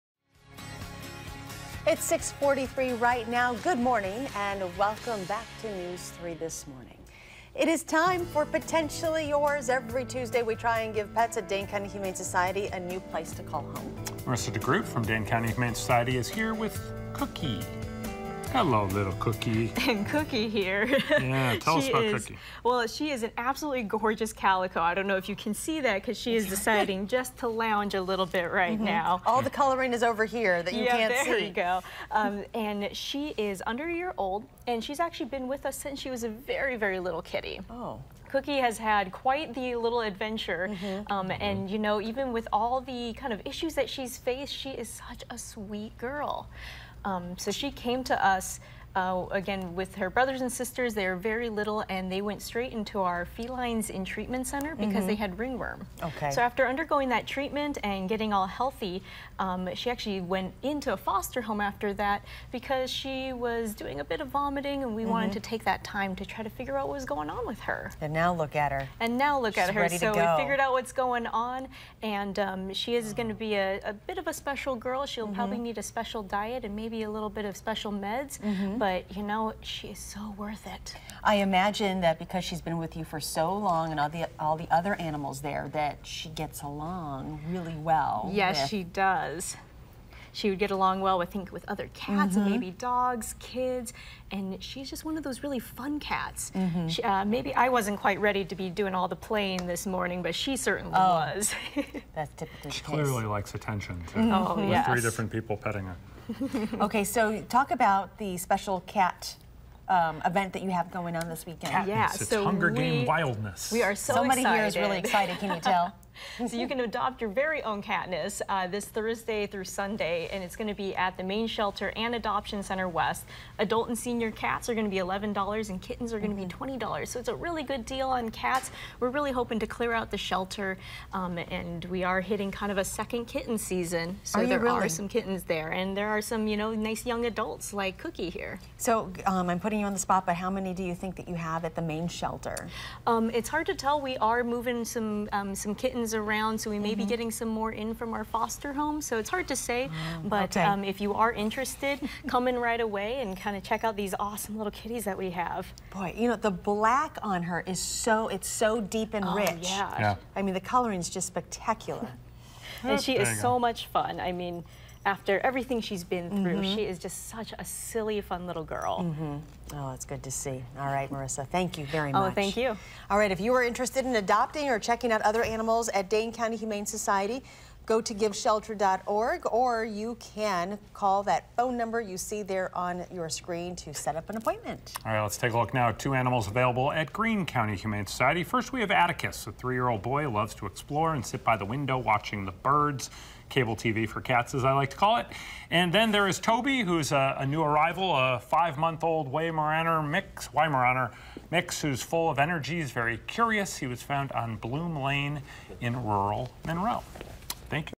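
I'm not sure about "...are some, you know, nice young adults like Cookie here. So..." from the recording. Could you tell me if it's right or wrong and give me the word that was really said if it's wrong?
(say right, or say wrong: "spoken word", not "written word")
right.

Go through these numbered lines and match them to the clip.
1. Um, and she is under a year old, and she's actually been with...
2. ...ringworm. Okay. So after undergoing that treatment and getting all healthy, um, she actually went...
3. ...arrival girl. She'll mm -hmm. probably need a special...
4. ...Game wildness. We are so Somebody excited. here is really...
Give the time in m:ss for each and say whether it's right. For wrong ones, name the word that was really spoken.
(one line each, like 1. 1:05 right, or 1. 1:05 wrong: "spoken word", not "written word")
1. 0:32 right
2. 0:55 right
3. 1:14 wrong: "special", not "arrival"
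4. 1:52 right.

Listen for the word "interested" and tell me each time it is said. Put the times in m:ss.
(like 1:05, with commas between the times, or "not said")
2:31, 2:53.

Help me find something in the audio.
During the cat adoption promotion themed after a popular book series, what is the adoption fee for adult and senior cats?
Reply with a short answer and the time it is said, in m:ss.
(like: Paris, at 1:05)
$11, at 2:04.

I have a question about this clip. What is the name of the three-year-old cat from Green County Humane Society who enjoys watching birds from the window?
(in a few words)
Atticus.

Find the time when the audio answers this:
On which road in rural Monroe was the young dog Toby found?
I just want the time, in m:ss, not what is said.
3:24.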